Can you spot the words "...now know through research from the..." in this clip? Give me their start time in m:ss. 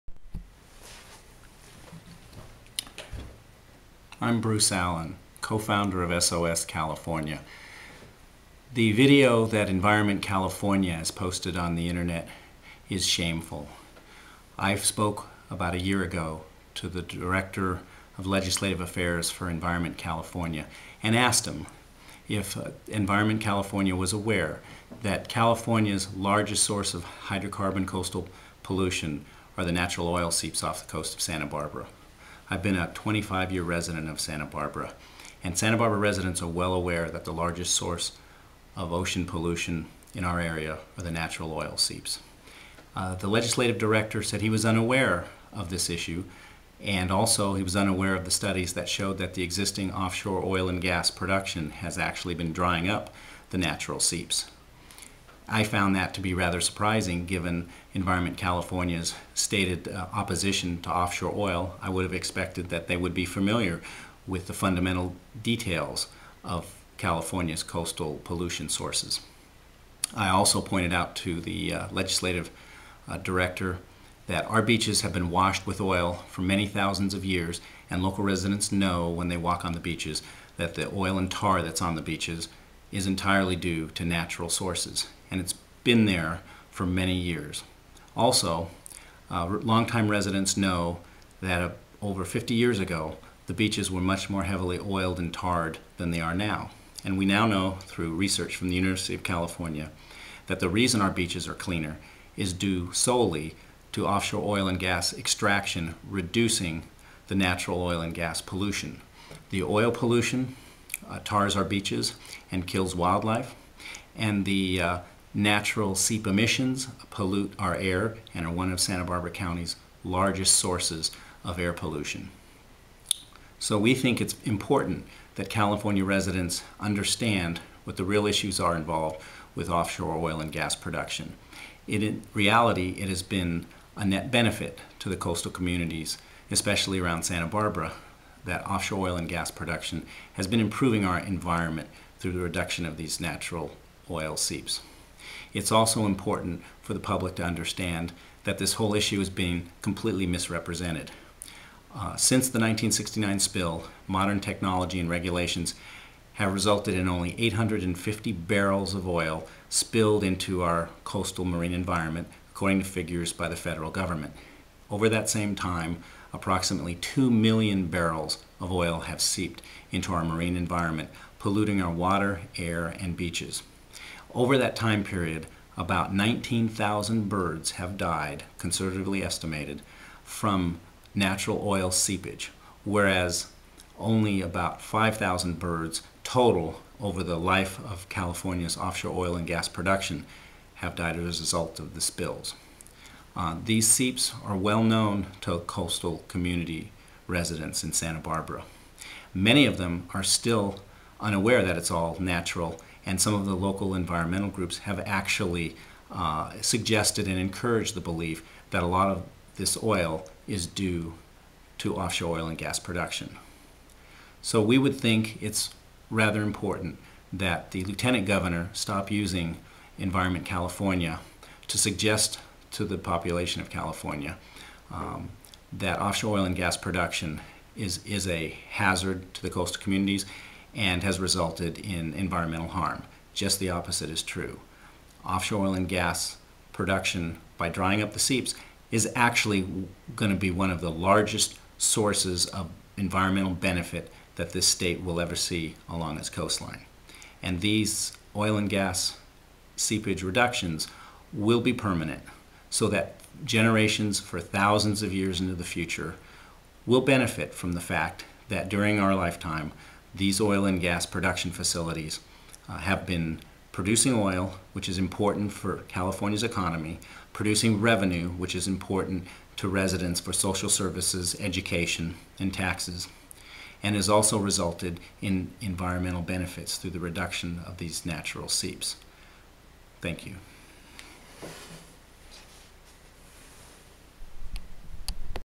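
1:37.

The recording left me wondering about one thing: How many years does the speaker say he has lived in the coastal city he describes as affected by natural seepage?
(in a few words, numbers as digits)
25.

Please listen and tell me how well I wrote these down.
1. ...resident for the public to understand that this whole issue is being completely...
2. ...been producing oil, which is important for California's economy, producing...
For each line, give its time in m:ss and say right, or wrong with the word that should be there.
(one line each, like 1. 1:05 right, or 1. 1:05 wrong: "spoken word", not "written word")
1. 2:26 wrong: "important", not "resident"
2. 4:23 right.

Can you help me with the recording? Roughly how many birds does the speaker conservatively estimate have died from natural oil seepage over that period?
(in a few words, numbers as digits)
19,000.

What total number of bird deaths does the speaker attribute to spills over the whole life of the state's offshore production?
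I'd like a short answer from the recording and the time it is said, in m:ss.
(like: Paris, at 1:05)
5,000, at 3:04.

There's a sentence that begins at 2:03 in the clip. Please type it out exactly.
So we think it's important that California residents understand what the real issues are involved with offshore oil and gas production.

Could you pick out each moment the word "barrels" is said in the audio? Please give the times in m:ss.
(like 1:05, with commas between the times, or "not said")
2:38, 2:47.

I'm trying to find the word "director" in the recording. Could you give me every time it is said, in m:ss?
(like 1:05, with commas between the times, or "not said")
0:17, 0:43, 1:13.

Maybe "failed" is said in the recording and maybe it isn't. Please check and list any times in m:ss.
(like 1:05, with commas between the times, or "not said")
not said.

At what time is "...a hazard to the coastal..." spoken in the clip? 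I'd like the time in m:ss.
3:48.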